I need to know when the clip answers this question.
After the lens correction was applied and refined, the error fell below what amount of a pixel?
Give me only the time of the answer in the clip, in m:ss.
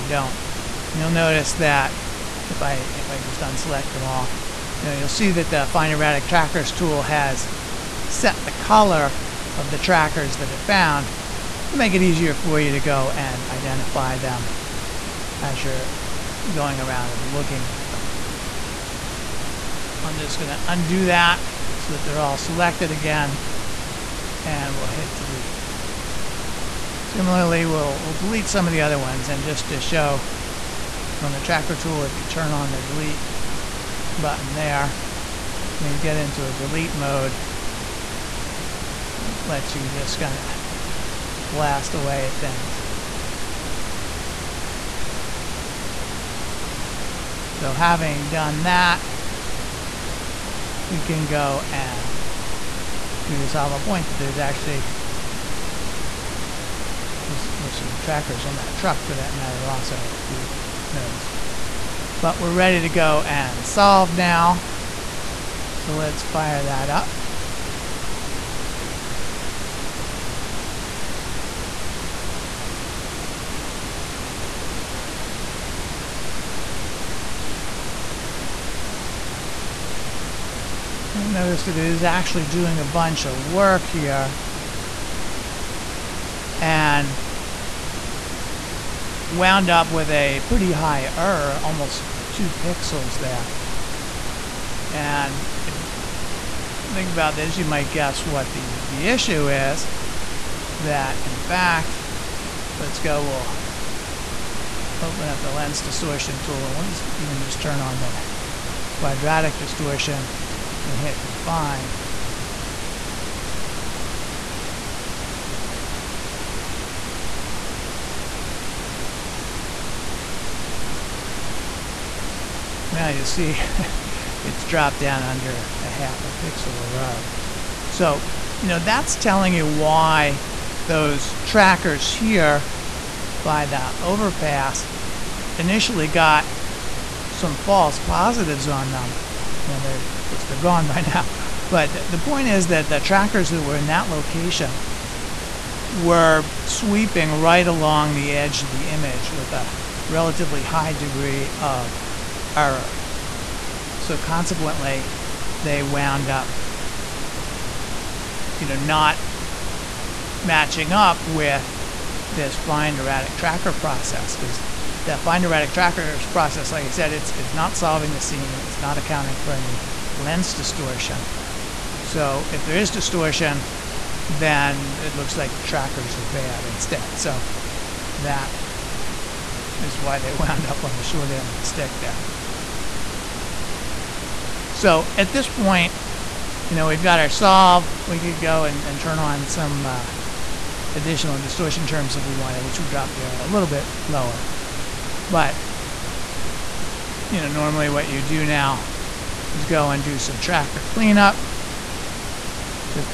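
2:05.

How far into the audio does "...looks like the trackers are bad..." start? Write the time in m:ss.
2:55.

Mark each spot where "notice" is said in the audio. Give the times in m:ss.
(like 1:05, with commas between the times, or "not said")
0:01, 1:00, 1:21.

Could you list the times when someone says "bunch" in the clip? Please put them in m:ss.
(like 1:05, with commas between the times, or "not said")
1:22.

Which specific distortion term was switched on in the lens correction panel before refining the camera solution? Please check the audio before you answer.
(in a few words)
quadratic distortion.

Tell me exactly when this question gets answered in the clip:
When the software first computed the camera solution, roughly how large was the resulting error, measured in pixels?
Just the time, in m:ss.
1:32.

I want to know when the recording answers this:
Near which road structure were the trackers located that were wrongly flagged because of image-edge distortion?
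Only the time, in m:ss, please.
2:14.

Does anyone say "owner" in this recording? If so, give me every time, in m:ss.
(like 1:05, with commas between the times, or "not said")
not said.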